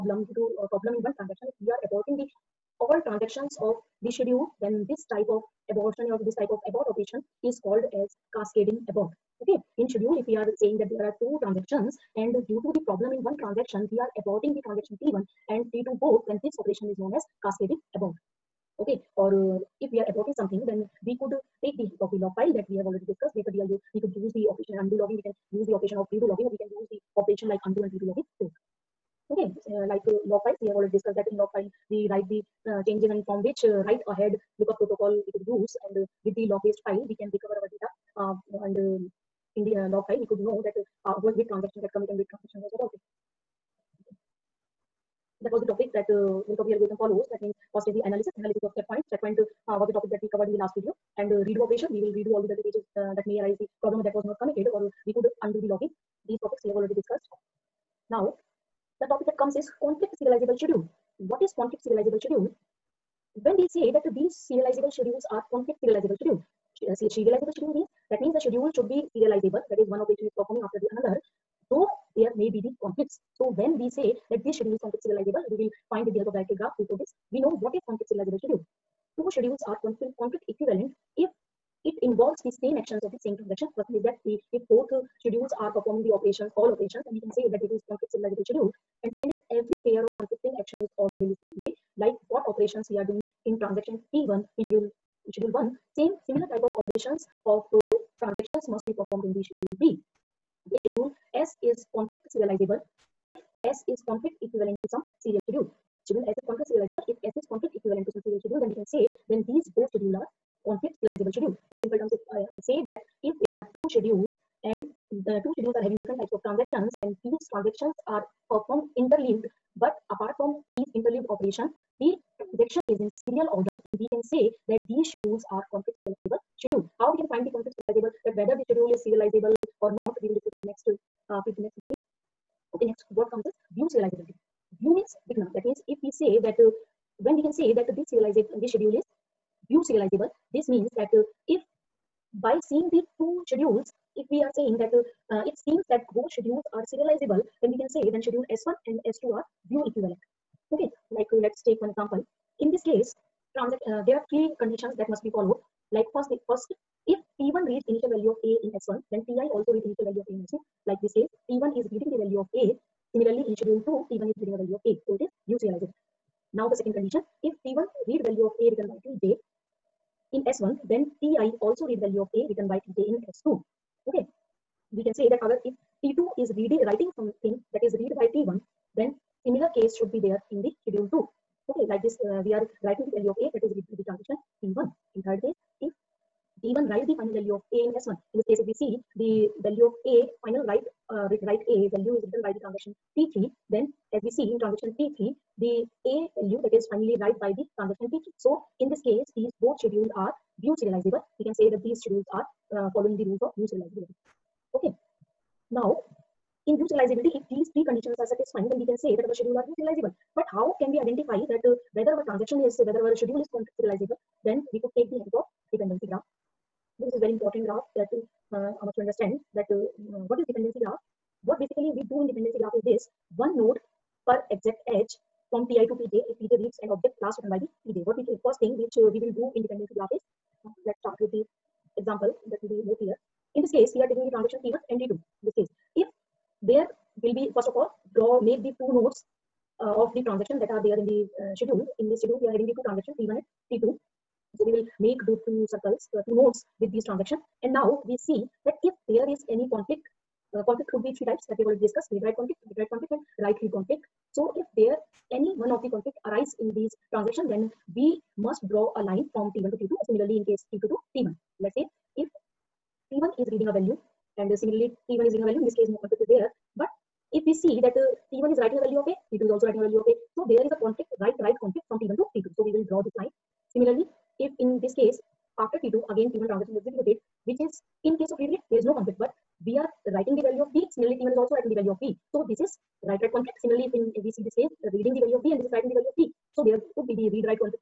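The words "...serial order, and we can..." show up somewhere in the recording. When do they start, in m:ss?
2:03.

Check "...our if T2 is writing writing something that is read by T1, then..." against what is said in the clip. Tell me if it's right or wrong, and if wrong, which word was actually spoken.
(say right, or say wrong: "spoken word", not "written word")
wrong: "reading", not "writing".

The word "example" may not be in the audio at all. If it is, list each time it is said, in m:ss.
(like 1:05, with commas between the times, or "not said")
2:31, 3:51.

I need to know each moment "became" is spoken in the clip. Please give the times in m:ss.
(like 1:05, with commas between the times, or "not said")
not said.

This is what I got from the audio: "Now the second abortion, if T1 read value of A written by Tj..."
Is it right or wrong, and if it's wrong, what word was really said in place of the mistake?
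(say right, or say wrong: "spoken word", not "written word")
wrong: "condition", not "abortion".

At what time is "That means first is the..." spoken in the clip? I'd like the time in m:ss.
0:47.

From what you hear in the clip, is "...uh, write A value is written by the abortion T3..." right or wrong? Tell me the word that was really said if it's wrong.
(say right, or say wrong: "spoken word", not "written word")
wrong: "transaction", not "abortion".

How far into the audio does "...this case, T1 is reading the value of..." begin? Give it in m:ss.
2:41.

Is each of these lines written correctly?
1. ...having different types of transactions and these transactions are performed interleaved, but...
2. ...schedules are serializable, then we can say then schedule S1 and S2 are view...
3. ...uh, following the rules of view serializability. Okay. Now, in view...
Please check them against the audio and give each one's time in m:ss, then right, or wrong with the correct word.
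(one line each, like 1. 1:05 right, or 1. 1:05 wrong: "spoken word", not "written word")
1. 1:55 right
2. 2:26 right
3. 3:22 right.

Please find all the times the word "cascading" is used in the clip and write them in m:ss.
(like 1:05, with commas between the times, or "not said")
0:08, 0:17.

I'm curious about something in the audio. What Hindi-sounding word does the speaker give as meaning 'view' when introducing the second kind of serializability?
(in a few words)
Vigna.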